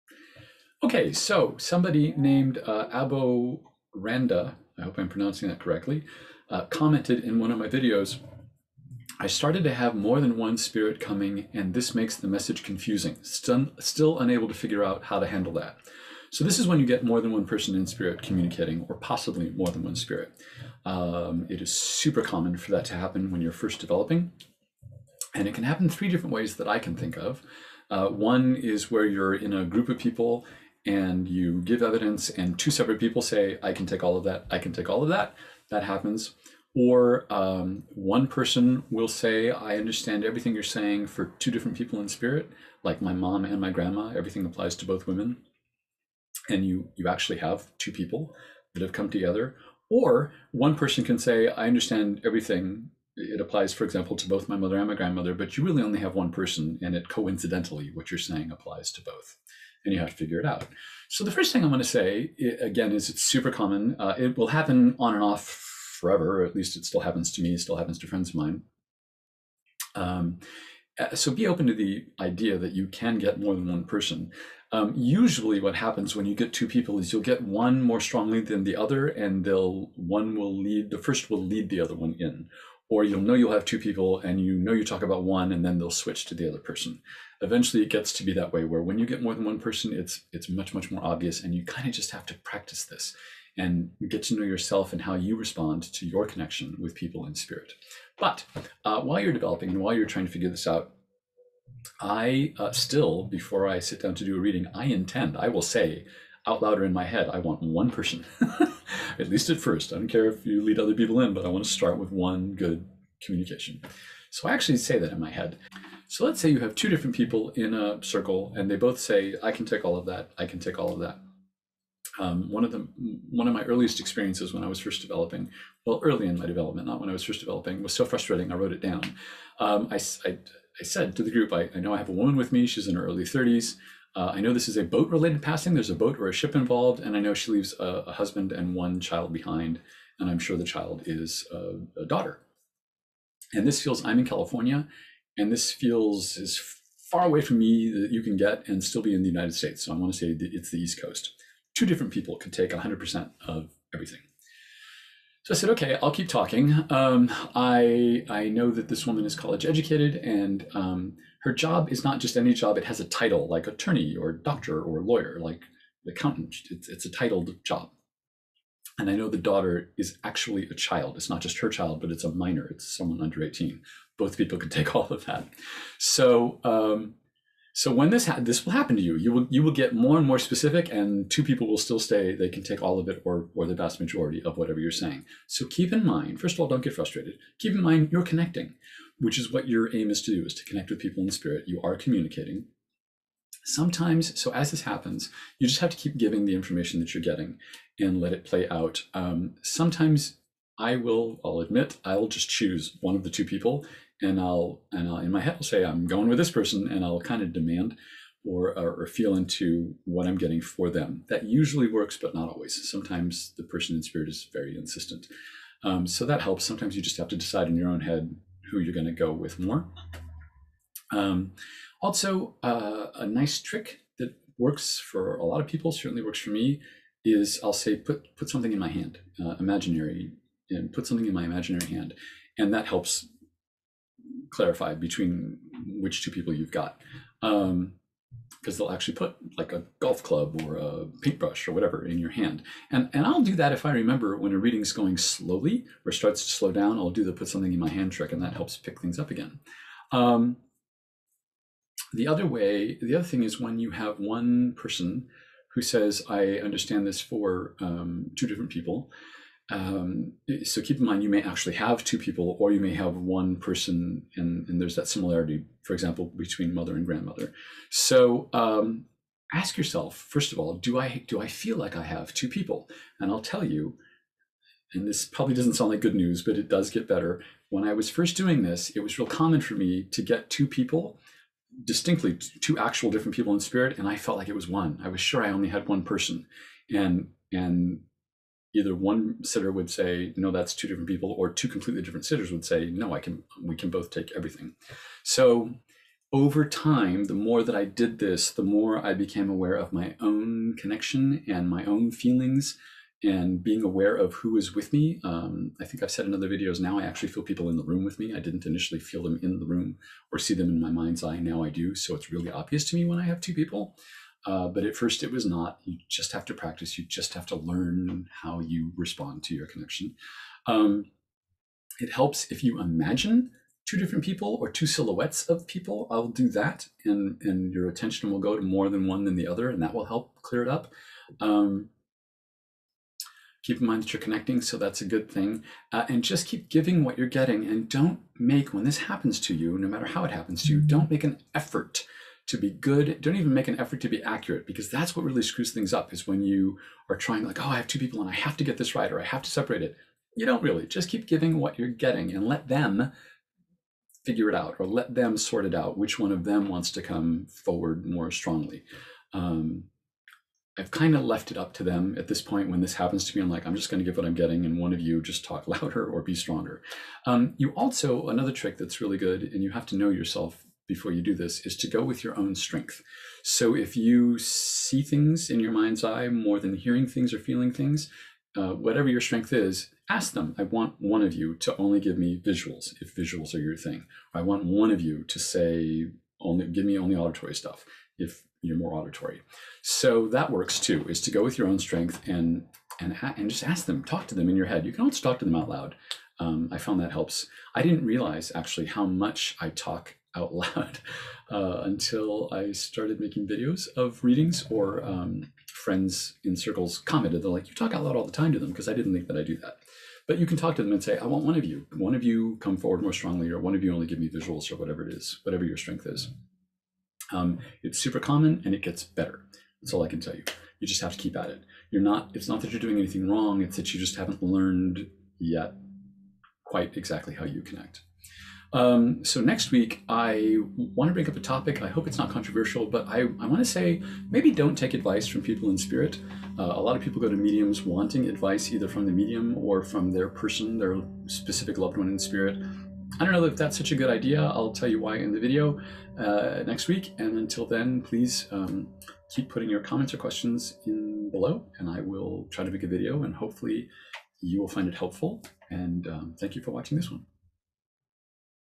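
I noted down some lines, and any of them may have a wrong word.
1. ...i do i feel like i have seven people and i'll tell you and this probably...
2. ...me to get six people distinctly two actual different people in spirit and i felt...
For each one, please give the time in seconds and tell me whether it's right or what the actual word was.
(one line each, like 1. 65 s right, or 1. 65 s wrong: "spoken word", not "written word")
1. 270 s wrong: "two", not "seven"
2. 279 s wrong: "two", not "six".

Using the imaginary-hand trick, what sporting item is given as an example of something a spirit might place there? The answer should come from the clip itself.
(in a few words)
Golf club.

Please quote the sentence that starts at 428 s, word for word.
Um, so next week, I want to bring up a topic.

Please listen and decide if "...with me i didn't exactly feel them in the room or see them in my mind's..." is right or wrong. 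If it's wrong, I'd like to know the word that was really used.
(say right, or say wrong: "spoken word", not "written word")
wrong: "initially", not "exactly".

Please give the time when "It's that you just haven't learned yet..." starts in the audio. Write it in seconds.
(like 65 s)
423 s.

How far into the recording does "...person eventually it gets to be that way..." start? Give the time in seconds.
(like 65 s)
86 s.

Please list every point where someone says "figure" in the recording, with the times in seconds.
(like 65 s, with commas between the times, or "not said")
14 s, 60 s, 100 s, 354 s.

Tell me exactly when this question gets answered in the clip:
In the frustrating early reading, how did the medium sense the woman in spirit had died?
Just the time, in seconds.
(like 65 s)
134 s.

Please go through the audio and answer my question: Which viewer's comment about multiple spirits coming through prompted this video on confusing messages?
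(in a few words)
Abo Randa.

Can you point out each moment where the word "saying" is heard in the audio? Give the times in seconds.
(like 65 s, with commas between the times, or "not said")
40 s, 58 s, 184 s.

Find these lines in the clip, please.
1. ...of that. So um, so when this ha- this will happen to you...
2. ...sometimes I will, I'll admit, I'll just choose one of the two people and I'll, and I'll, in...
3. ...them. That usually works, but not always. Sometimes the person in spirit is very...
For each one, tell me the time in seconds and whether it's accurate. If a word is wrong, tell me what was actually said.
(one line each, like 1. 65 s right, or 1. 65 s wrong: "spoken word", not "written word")
1. 175 s right
2. 199 s right
3. 210 s right.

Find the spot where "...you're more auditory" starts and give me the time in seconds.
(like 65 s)
388 s.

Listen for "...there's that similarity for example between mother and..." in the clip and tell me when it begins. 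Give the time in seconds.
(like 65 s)
264 s.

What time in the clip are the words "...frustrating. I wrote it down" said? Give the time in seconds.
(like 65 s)
128 s.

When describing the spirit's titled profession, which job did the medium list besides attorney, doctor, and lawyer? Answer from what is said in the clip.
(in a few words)
Accountant.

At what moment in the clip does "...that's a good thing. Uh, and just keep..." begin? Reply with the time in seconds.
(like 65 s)
334 s.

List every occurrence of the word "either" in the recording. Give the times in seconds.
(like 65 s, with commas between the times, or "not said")
288 s, 438 s.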